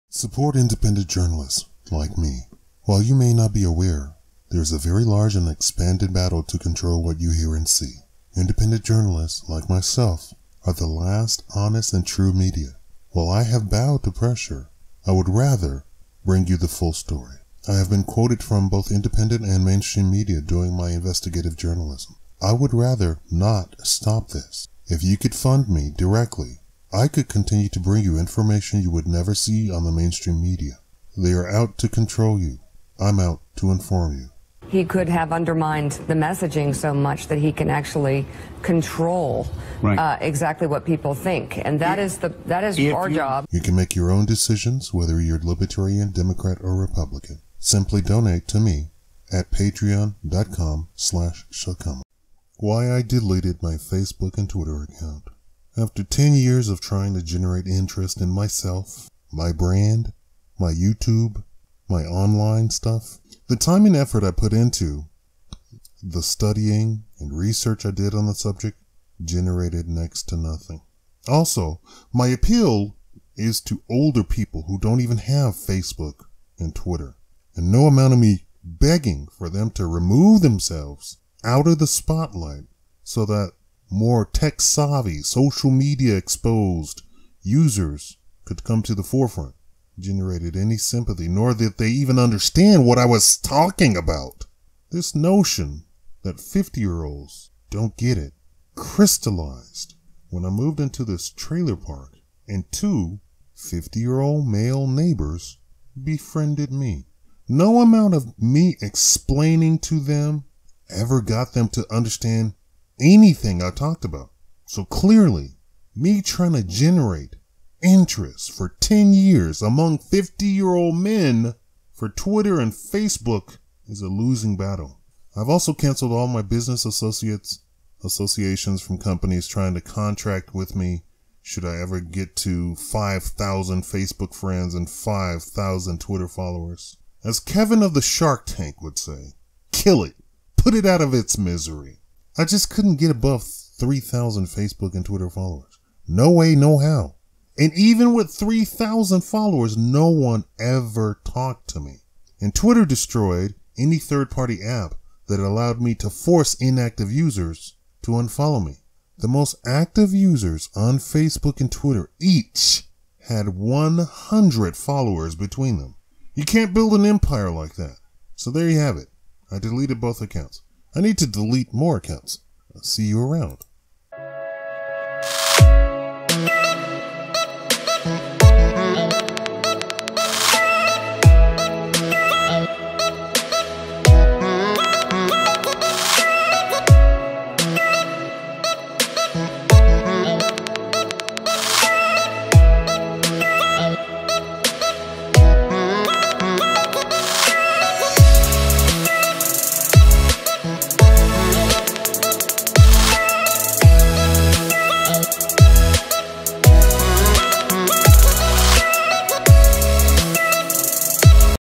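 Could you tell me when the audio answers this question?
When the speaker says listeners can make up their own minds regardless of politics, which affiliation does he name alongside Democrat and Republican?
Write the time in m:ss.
0:45.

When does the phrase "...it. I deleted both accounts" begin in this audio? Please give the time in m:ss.
2:48.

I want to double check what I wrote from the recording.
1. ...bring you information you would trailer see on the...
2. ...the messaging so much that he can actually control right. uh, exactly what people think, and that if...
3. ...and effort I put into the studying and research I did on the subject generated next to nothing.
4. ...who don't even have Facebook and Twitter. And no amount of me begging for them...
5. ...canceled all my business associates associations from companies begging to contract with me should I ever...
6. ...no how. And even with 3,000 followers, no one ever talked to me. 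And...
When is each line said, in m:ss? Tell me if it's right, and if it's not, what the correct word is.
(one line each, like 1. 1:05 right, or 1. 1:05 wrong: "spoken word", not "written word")
1. 0:27 wrong: "never", not "trailer"
2. 0:36 right
3. 1:03 right
4. 1:14 right
5. 2:05 wrong: "trying", not "begging"
6. 2:26 right.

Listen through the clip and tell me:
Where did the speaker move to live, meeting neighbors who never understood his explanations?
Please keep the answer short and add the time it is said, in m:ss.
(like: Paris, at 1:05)
Trailer park, at 1:41.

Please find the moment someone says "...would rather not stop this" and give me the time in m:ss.
0:22.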